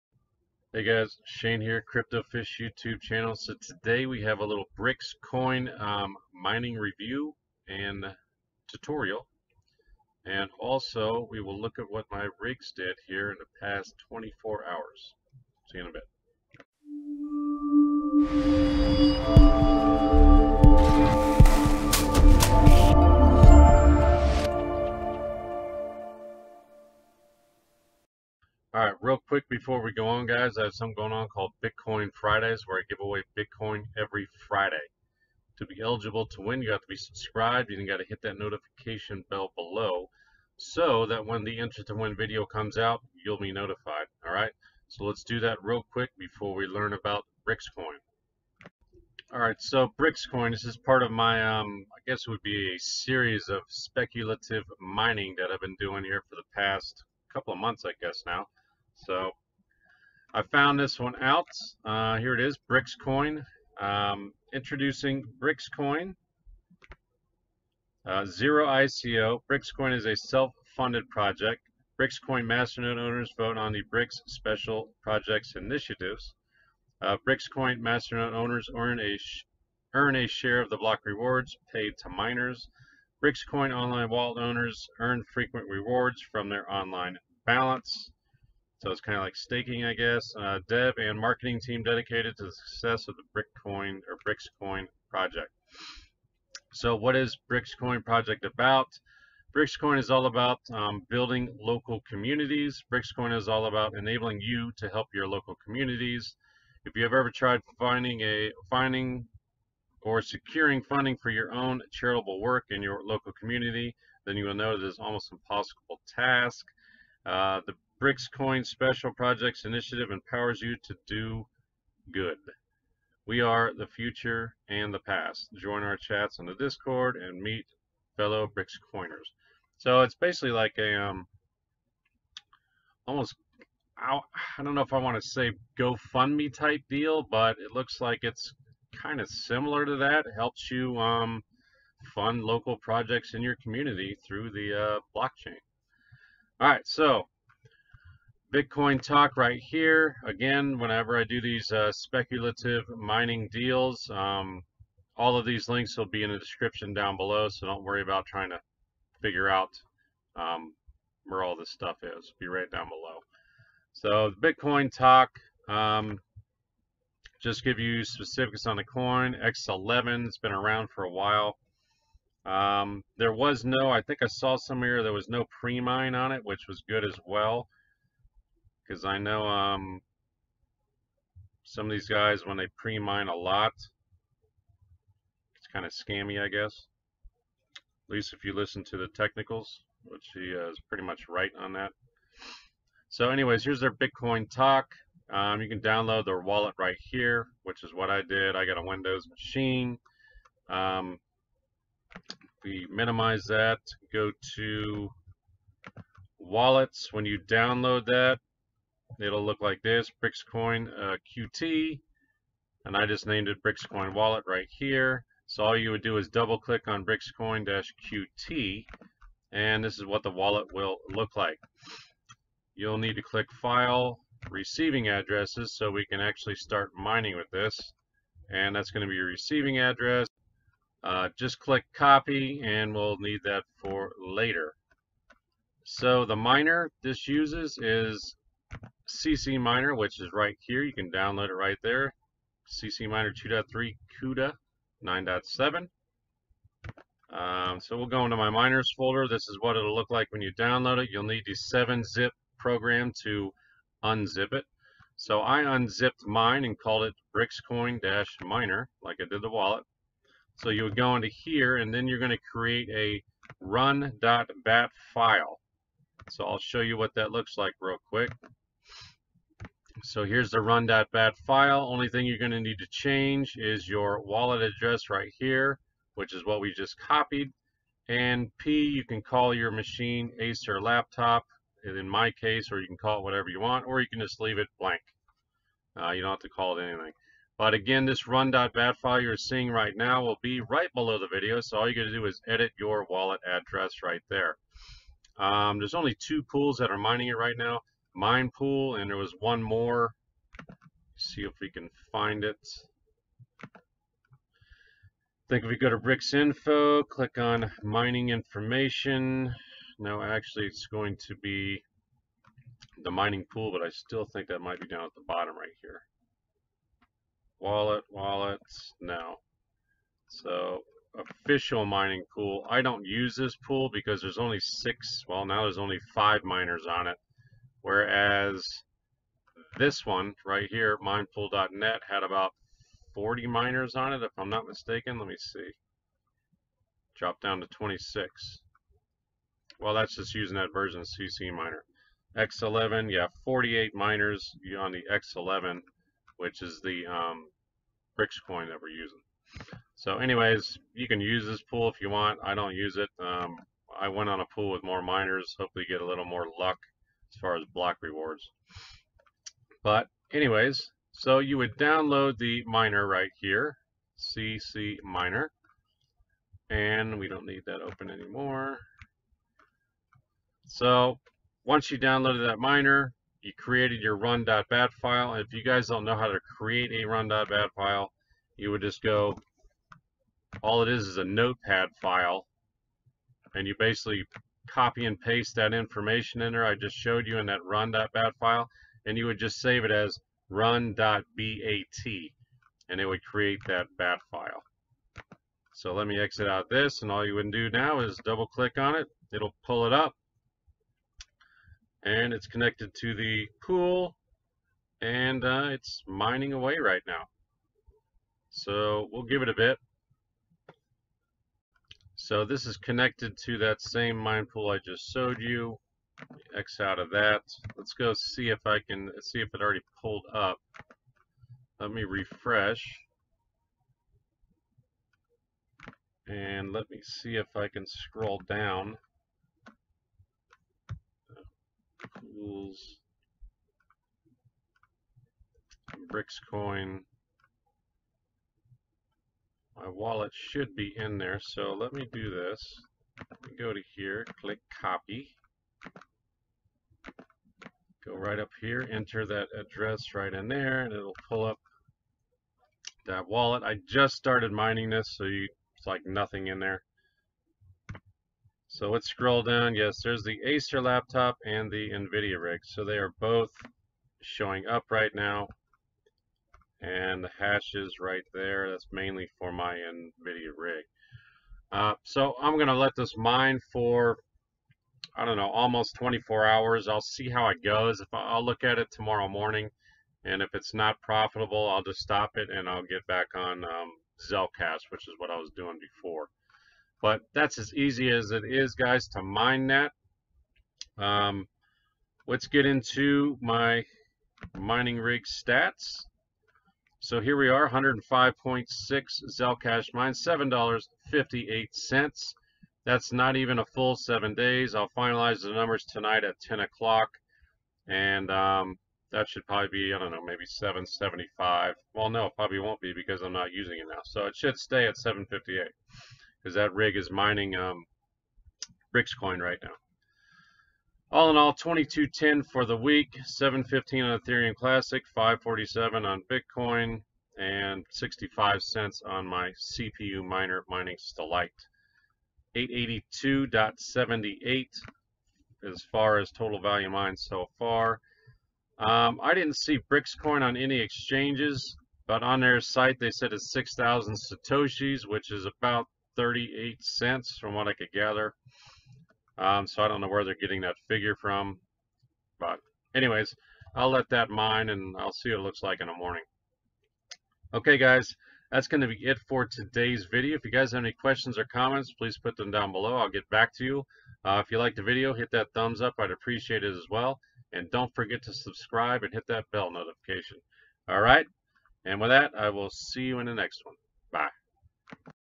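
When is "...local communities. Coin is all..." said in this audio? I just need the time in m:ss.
1:41.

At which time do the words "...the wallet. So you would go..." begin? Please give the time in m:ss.
4:19.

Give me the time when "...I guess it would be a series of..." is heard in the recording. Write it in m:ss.
0:51.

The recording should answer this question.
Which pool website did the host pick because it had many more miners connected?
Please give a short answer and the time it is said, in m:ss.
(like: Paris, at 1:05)
minpool.net, at 5:30.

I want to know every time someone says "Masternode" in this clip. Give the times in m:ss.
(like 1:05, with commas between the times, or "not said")
1:12, 1:17.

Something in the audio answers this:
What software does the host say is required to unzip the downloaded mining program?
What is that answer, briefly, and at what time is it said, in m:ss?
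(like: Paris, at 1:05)
7-zip, at 4:11.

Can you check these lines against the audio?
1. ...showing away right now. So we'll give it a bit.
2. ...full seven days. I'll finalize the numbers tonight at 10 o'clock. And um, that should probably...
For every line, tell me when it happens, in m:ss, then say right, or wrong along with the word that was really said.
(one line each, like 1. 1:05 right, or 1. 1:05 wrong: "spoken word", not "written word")
1. 6:46 wrong: "mining", not "showing"
2. 8:23 right.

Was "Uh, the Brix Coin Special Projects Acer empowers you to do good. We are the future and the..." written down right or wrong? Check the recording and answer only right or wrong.
wrong.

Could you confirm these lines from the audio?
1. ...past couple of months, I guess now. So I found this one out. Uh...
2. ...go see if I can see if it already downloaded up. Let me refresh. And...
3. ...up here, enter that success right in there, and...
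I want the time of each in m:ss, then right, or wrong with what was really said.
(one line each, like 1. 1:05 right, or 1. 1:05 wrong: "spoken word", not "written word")
1. 0:56 right
2. 6:57 wrong: "pulled", not "downloaded"
3. 7:28 wrong: "address", not "success".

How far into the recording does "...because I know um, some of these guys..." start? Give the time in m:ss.
2:58.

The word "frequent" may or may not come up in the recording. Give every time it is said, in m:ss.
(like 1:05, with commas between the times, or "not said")
1:25.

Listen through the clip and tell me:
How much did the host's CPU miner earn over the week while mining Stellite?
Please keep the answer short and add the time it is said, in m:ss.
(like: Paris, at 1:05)
65 cents, at 8:47.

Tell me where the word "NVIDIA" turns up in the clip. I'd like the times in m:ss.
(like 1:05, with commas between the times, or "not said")
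7:41, 7:49.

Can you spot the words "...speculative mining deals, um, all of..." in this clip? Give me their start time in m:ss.
2:31.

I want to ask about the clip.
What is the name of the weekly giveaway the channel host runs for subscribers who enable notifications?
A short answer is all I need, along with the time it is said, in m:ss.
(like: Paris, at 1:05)
Bitcoin Fridays, at 0:31.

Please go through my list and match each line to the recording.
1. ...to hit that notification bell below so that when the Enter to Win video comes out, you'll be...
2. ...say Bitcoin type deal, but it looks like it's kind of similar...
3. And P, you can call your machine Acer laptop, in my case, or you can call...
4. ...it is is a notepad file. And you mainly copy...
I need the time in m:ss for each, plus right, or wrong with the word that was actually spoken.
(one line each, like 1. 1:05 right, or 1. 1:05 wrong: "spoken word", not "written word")
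1. 0:37 right
2. 2:15 wrong: "GoFundMe", not "Bitcoin"
3. 4:38 right
4. 6:20 wrong: "basically", not "mainly".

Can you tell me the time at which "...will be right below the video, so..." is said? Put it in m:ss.
4:50.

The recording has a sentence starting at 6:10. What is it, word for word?
So once you downloaded that miner, you created your run.bat file.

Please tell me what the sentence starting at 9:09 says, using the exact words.
Um, so I don't know where they're getting that figure from.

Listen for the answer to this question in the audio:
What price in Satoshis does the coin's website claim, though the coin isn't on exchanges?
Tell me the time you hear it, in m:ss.
9:03.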